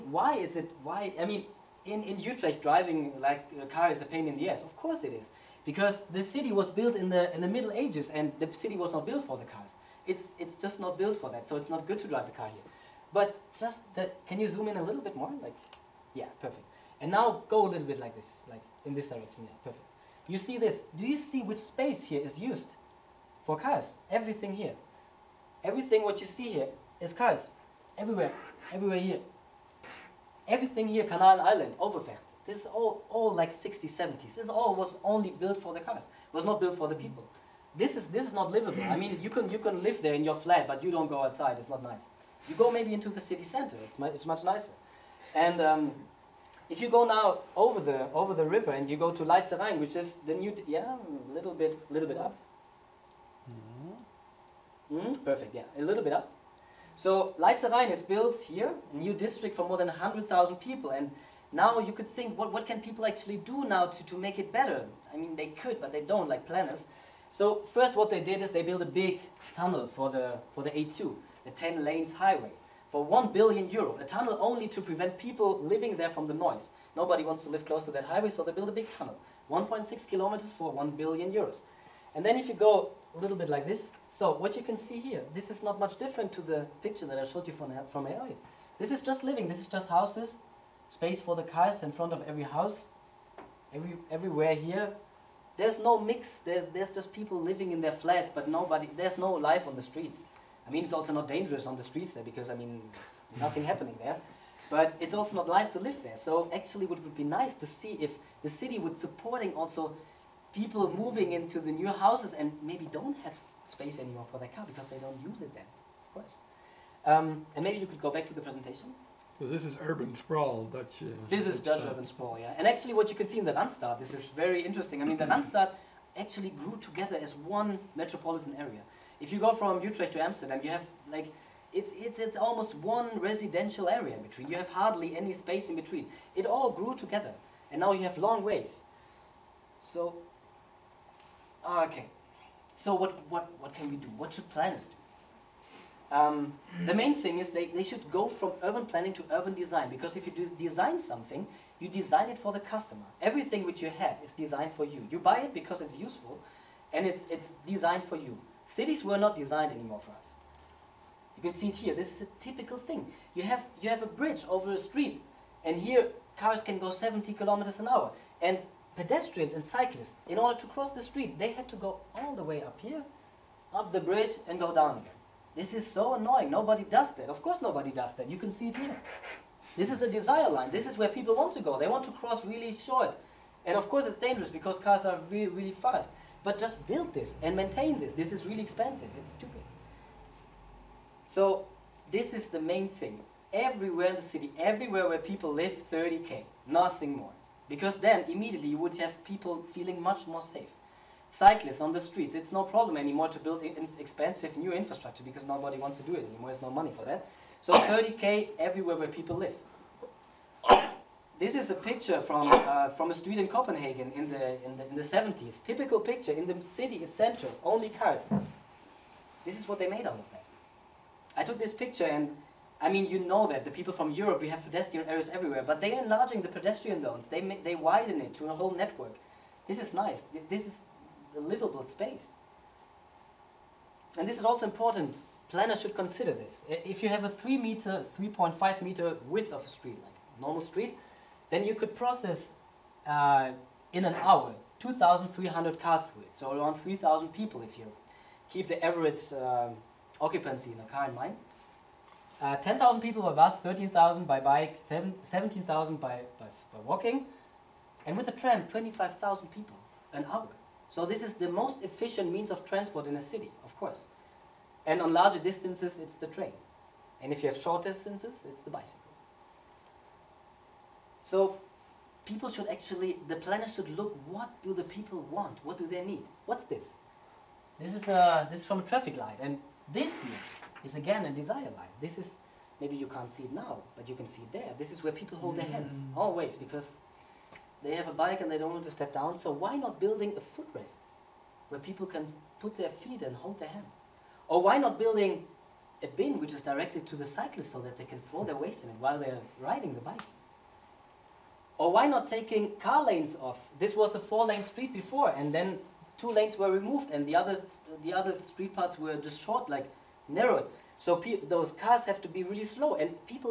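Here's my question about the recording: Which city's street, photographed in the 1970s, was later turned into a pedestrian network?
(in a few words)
Copenhagen.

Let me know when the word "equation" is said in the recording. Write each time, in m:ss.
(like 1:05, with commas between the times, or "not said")
not said.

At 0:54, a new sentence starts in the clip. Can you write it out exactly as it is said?
Mm, perfect, yeah, a little bit up.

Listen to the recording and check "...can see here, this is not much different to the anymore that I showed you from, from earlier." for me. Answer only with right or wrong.
wrong.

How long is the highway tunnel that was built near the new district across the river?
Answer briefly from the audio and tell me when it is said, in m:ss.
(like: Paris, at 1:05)
1.6 kilometers, at 1:19.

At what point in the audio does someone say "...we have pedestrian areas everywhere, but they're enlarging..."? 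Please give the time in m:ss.
3:44.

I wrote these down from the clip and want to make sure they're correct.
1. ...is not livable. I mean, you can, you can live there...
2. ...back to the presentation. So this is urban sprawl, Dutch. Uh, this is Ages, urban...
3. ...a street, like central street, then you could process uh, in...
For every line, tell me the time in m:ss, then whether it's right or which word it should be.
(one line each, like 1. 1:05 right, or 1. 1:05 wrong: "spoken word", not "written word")
1. 0:38 right
2. 1:58 wrong: "Dutch", not "Ages"
3. 3:59 wrong: "normal", not "central".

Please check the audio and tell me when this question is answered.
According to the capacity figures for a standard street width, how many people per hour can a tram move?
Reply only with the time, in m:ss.
4:18.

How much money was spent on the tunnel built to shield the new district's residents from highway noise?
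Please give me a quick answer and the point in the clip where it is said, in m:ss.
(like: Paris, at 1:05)
1 billion euros, at 1:20.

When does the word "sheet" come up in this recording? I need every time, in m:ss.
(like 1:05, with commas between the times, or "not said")
not said.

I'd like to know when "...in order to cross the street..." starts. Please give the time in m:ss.
2:50.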